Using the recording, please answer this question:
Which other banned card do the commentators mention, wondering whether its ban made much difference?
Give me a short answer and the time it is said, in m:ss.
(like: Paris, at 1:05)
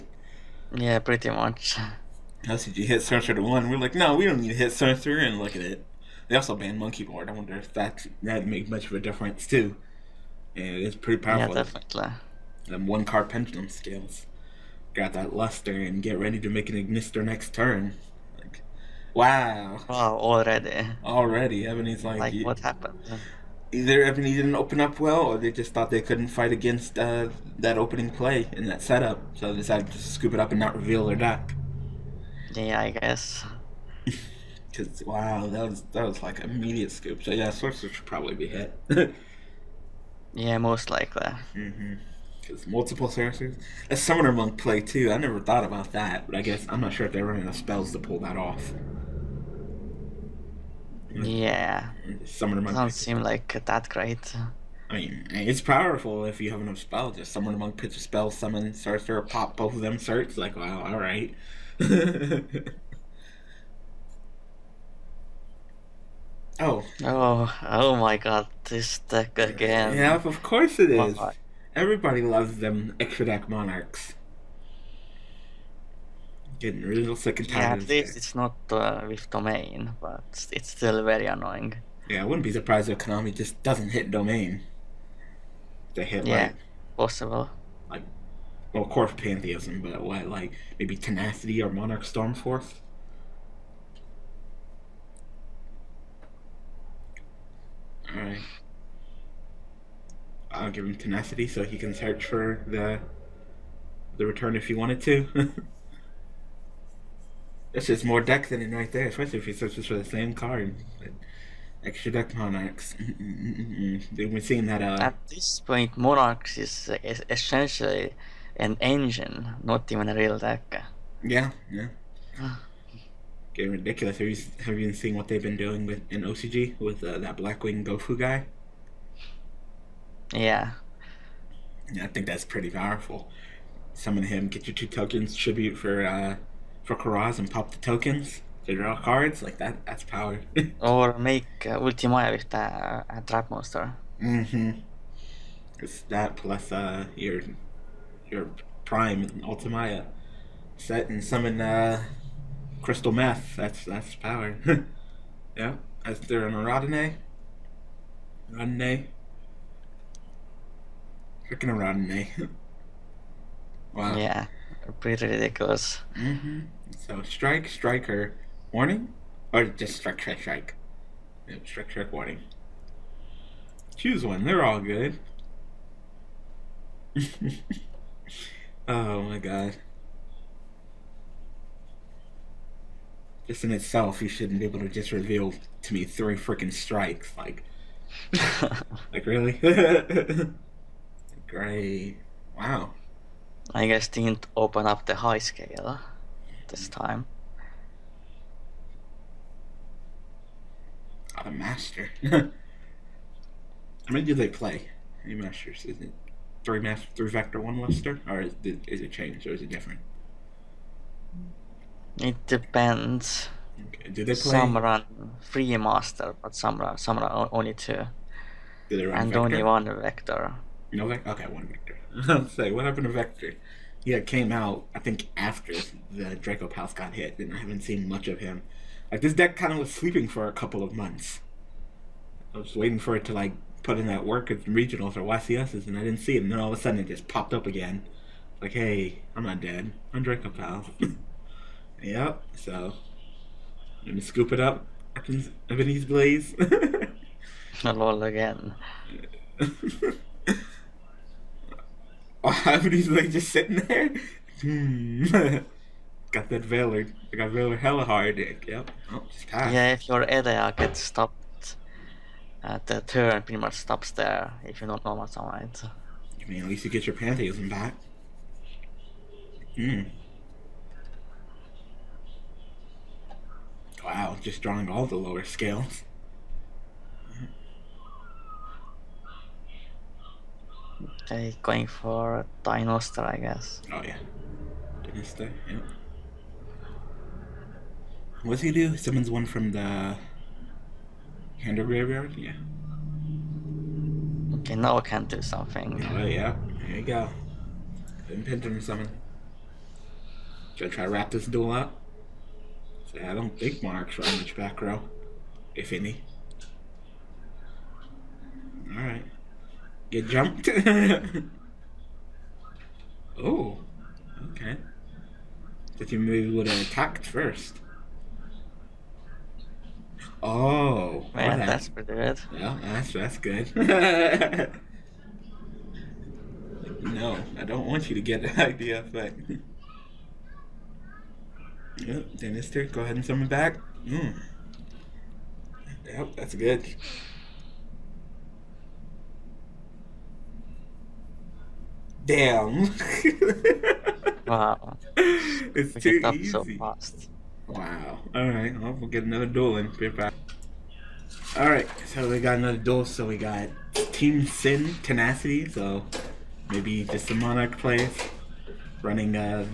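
Monkey Board, at 0:06.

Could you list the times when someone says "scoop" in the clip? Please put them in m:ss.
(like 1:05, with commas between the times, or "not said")
0:29, 0:36, 4:04.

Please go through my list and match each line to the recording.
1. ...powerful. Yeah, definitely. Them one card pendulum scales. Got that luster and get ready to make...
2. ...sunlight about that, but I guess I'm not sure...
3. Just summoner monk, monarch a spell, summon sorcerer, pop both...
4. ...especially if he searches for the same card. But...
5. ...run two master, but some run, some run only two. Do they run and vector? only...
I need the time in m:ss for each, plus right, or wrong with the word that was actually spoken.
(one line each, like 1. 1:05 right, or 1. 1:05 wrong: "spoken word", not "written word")
1. 0:11 right
2. 0:45 wrong: "thought", not "sunlight"
3. 0:57 wrong: "pitch", not "monarch"
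4. 1:49 right
5. 3:34 wrong: "three", not "two".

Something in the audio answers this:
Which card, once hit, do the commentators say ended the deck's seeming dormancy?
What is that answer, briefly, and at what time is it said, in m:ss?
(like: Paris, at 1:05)
Draco Palace, at 3:46.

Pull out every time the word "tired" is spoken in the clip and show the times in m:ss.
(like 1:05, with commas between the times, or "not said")
1:17, 4:19.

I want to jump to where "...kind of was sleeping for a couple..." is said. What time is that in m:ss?
3:49.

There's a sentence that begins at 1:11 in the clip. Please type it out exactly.
Everybody loves them extra deck monarchs.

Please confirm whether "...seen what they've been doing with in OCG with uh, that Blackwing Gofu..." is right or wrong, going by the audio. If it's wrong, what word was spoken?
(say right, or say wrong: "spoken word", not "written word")
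right.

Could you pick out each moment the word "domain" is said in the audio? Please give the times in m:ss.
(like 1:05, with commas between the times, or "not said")
1:19, 1:24.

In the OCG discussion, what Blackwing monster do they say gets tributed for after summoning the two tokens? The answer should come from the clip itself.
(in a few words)
Kuraz.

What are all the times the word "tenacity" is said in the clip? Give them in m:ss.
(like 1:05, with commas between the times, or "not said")
1:30, 1:40, 5:55.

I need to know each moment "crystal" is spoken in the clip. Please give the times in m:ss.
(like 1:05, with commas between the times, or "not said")
2:32.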